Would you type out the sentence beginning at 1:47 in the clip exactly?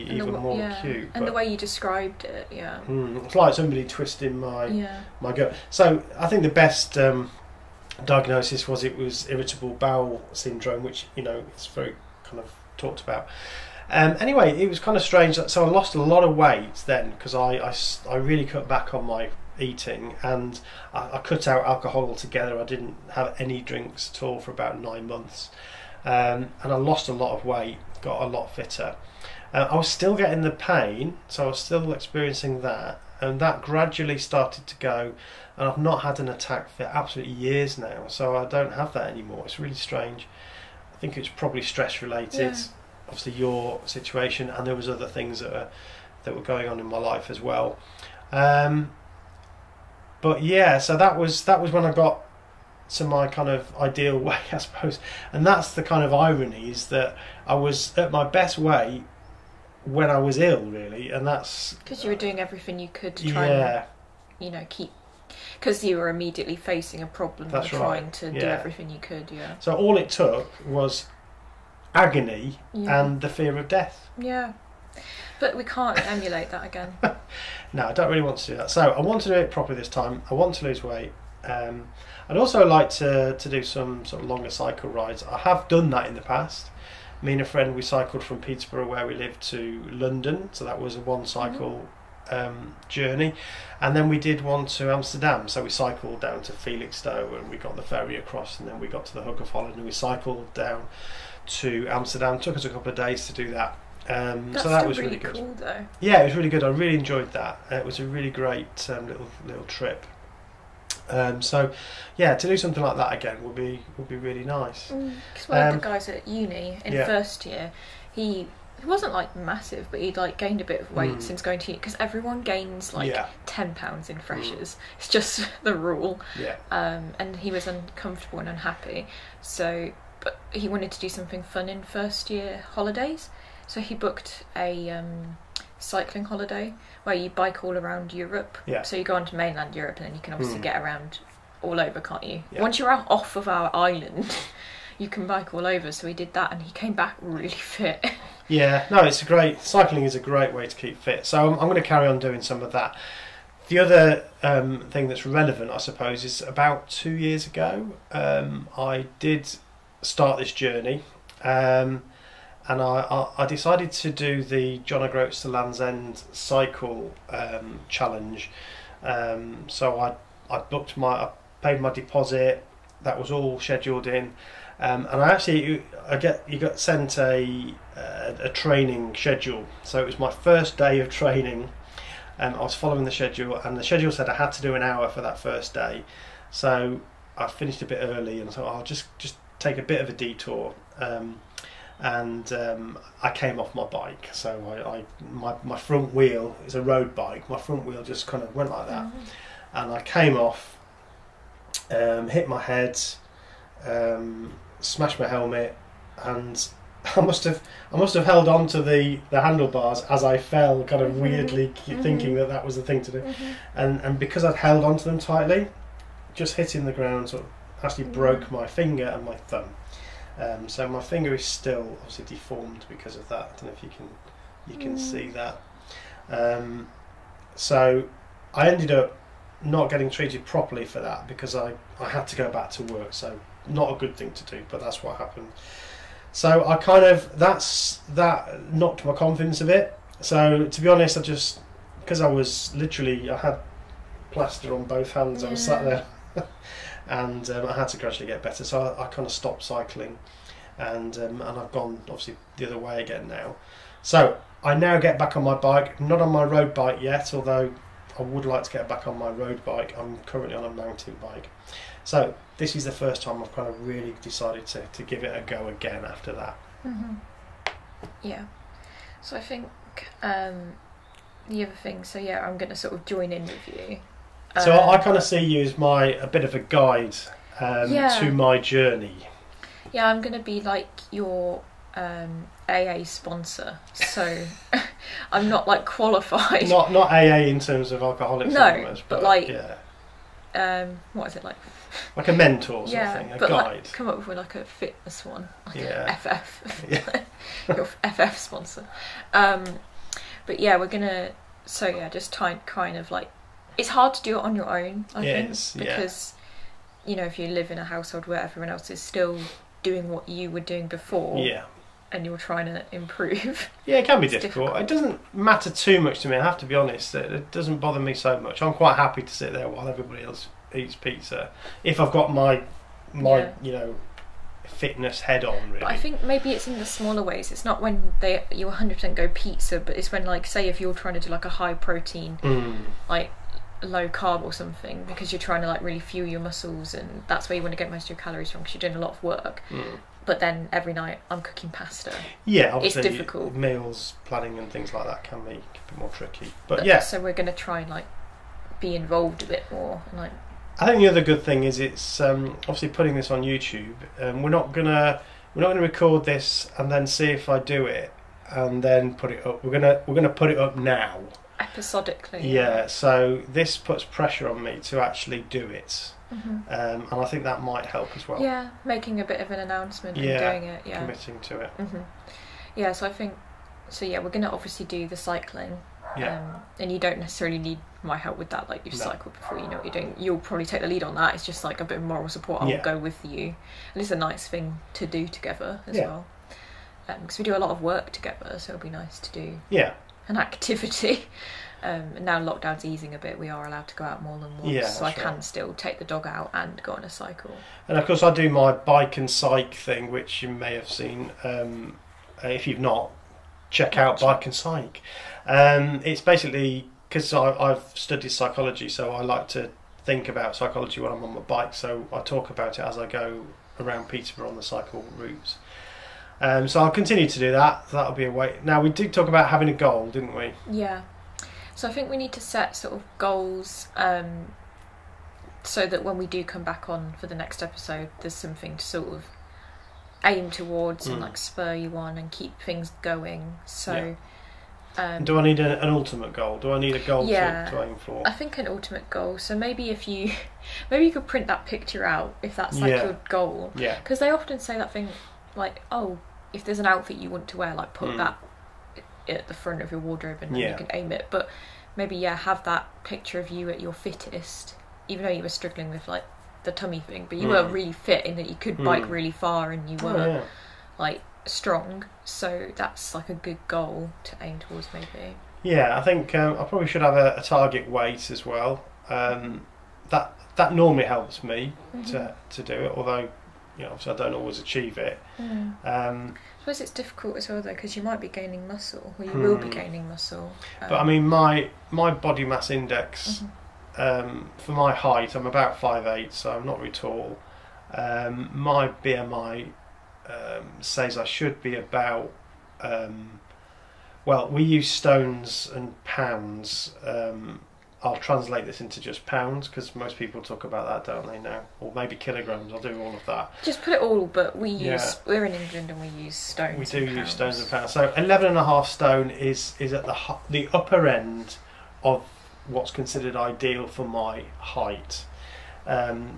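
Uh, it was a really great um, little little trip.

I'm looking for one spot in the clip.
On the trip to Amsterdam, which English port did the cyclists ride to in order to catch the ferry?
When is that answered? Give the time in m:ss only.
1:36.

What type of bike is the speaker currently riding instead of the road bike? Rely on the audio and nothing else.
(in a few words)
Mountain bike.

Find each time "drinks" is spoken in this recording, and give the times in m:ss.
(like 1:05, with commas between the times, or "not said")
0:23.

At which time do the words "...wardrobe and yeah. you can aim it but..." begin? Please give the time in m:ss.
7:30.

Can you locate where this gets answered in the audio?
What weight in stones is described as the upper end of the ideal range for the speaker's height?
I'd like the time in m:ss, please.
8:28.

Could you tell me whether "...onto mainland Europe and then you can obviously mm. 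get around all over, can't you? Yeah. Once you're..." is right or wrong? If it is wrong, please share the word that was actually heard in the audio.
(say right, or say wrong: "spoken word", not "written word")
right.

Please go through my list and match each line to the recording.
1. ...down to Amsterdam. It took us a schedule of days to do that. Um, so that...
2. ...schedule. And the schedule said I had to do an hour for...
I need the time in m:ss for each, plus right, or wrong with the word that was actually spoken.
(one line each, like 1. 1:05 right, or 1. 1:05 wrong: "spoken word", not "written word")
1. 1:40 wrong: "couple", not "schedule"
2. 3:03 right.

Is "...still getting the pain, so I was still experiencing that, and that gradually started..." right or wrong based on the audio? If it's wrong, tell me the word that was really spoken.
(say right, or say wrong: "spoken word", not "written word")
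right.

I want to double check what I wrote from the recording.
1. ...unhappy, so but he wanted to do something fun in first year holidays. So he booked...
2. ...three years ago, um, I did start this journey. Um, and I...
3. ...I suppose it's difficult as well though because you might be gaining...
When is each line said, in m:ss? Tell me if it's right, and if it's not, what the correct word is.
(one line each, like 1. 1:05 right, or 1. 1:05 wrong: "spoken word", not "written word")
1. 2:08 right
2. 2:36 wrong: "two", not "three"
3. 7:56 right.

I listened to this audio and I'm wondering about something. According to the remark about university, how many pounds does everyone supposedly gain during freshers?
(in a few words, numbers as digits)
10 pounds.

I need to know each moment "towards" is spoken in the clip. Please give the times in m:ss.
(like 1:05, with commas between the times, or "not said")
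7:10, 7:44.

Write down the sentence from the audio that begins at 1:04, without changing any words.
and you know keep because you were immediately facing a problem that's and right.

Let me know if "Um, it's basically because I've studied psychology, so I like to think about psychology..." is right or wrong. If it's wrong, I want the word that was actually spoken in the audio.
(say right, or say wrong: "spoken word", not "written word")
right.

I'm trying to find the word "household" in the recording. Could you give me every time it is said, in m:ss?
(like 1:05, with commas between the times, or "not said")
5:07.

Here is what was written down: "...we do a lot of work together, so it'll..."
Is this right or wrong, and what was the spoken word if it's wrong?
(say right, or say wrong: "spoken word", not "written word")
right.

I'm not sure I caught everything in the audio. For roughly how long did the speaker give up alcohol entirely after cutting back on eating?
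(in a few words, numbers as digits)
9 months.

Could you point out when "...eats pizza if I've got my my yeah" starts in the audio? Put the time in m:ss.
5:20.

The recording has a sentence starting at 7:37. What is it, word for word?
really fit in that you could mm.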